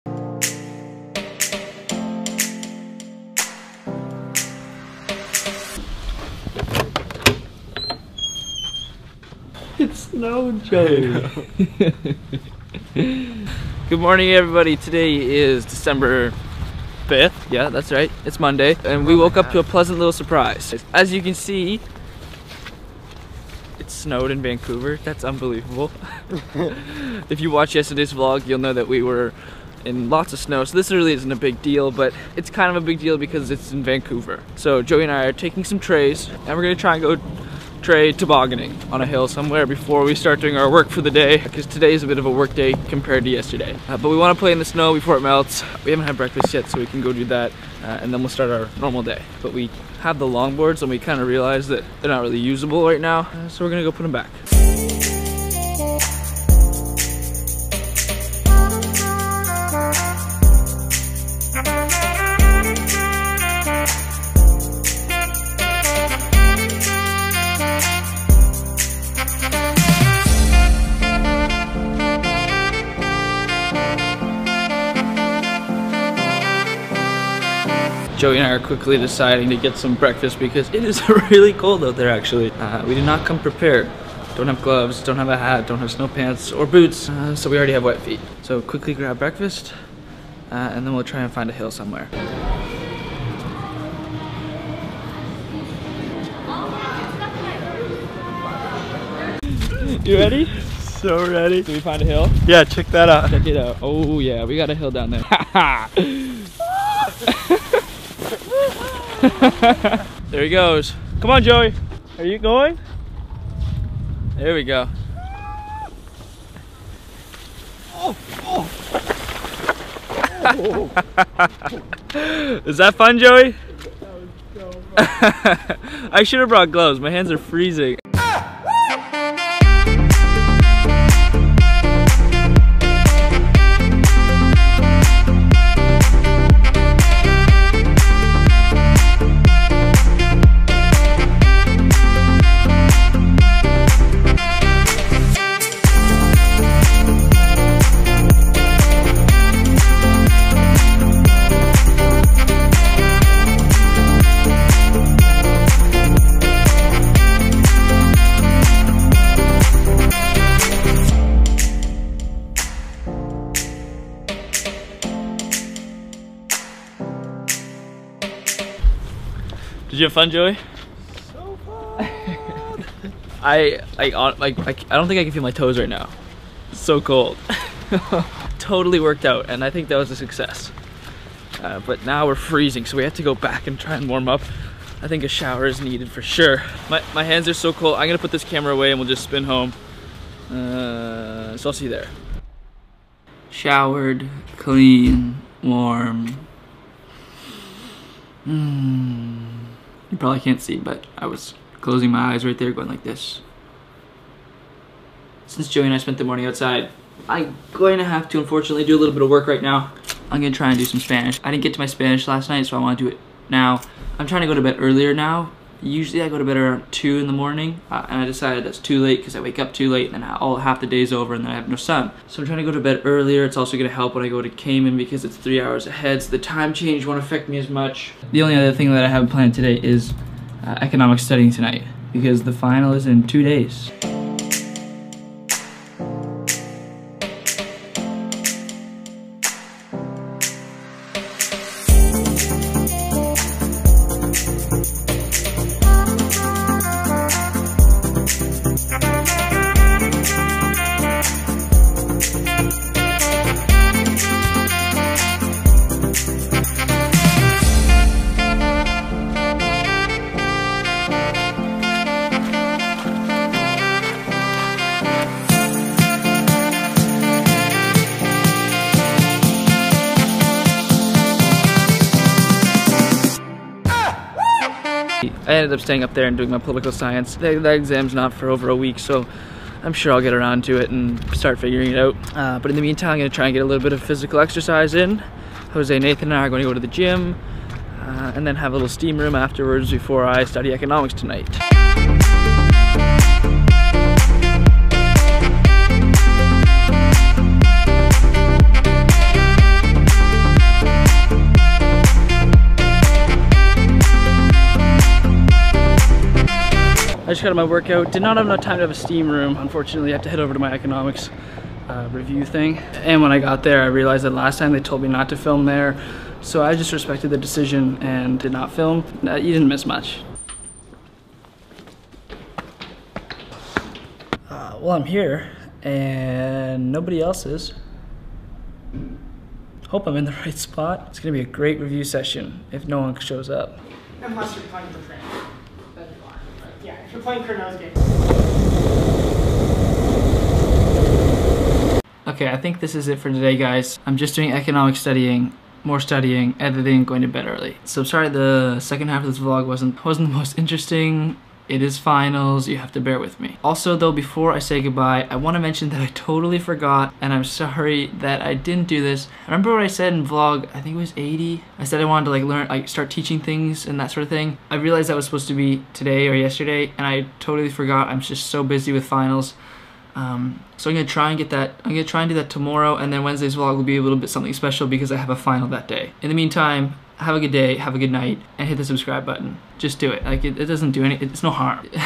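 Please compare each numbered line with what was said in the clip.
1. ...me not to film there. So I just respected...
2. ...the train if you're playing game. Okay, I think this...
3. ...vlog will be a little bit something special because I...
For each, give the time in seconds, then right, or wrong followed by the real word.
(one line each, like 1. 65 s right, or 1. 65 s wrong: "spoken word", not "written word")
1. 315 s right
2. 334 s right
3. 373 s right.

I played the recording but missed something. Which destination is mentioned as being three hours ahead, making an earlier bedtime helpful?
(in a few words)
Cayman.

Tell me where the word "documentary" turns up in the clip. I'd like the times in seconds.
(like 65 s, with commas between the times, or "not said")
not said.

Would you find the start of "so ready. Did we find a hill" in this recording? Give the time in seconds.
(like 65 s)
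100 s.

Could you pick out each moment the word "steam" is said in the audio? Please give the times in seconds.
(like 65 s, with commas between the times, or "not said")
288 s, 308 s.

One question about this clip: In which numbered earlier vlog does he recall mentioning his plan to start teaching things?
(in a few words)
80.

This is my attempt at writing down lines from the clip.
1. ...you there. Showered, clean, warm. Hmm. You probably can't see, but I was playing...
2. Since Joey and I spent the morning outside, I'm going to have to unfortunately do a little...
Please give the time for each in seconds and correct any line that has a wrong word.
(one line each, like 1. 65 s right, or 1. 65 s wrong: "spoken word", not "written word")
1. 191 s wrong: "closing", not "playing"
2. 205 s right.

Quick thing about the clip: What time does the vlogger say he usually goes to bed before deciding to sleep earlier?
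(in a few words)
2 in the morning.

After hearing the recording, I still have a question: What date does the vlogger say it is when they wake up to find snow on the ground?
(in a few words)
December 5th.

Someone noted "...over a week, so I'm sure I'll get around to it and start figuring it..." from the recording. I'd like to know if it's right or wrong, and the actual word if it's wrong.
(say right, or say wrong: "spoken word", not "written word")
right.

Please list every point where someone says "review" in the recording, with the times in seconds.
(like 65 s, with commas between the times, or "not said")
312 s, 331 s.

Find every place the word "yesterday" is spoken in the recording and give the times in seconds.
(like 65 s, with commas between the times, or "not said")
27 s, 43 s, 366 s.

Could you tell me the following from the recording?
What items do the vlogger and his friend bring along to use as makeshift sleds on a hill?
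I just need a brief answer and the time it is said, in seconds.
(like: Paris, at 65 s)
Trays, at 35 s.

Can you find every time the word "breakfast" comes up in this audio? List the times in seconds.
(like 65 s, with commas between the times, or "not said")
46 s, 79 s, 89 s.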